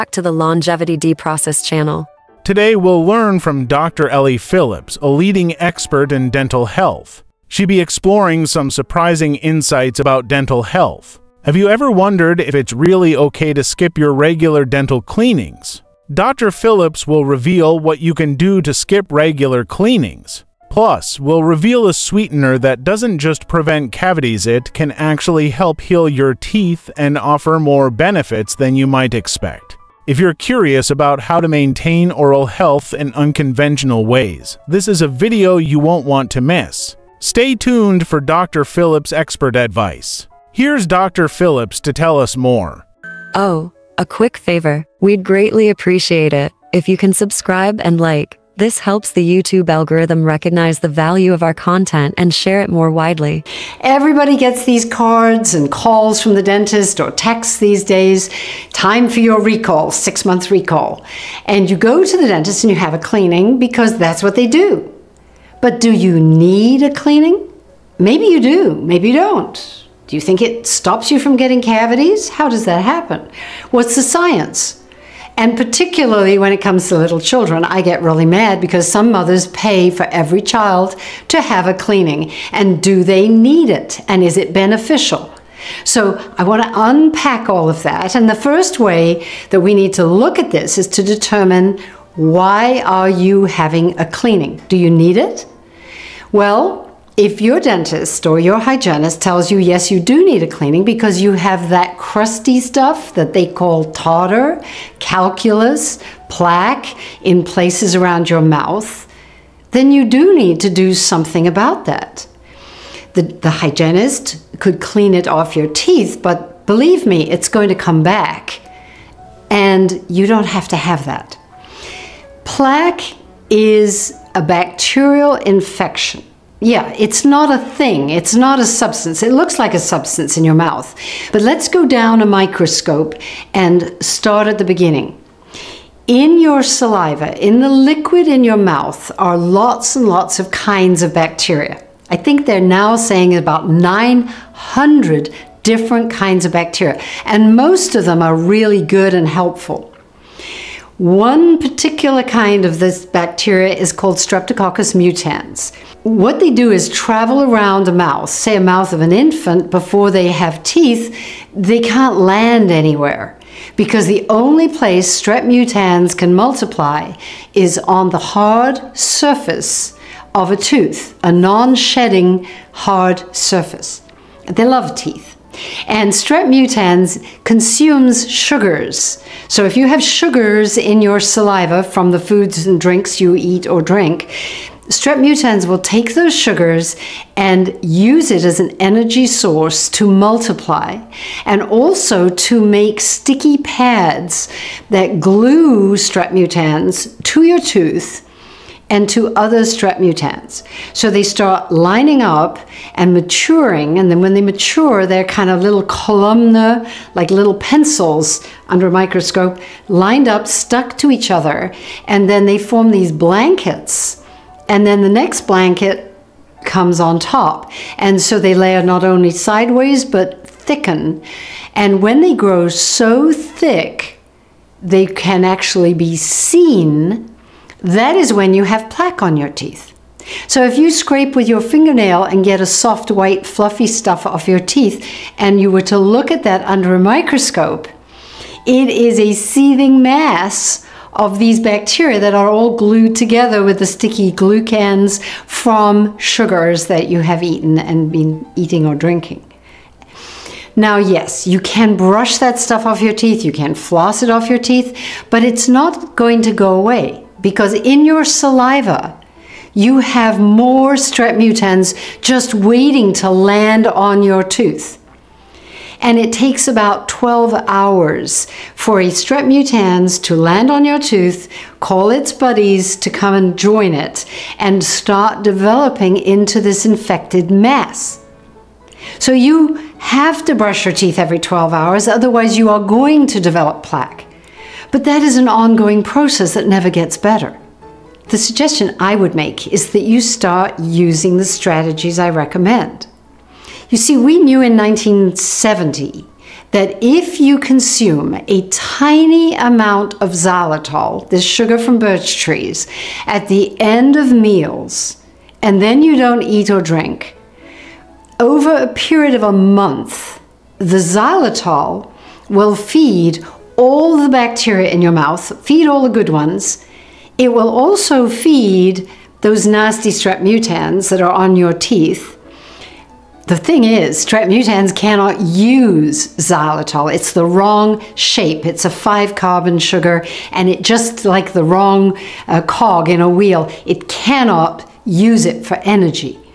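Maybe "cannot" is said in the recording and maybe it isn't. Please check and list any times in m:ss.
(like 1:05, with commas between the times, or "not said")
5:24, 5:34.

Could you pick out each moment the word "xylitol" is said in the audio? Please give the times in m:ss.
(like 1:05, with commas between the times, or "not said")
5:00, 5:11, 5:26.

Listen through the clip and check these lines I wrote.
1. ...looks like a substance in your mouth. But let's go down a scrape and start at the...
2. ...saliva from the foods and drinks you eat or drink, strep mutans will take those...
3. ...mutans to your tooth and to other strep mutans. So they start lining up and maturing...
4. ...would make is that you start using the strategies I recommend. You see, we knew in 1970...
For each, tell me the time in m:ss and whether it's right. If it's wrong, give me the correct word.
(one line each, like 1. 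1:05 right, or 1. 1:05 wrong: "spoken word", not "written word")
1. 2:09 wrong: "microscope", not "scrape"
2. 3:01 right
3. 3:16 right
4. 4:49 right.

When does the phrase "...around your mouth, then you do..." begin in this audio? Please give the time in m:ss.
1:47.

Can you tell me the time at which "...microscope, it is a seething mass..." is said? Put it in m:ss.
3:56.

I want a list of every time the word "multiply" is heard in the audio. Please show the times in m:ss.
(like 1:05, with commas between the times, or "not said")
2:46, 3:10.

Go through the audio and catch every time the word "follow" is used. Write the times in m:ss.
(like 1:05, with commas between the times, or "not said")
not said.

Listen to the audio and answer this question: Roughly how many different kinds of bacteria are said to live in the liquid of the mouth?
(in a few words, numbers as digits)
900.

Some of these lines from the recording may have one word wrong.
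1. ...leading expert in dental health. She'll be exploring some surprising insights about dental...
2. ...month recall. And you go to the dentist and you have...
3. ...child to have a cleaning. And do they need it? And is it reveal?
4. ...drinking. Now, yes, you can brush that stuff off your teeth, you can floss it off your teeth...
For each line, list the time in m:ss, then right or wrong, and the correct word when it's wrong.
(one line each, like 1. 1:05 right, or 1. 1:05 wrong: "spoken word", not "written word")
1. 0:05 right
2. 1:00 right
3. 1:20 wrong: "beneficial", not "reveal"
4. 4:08 right.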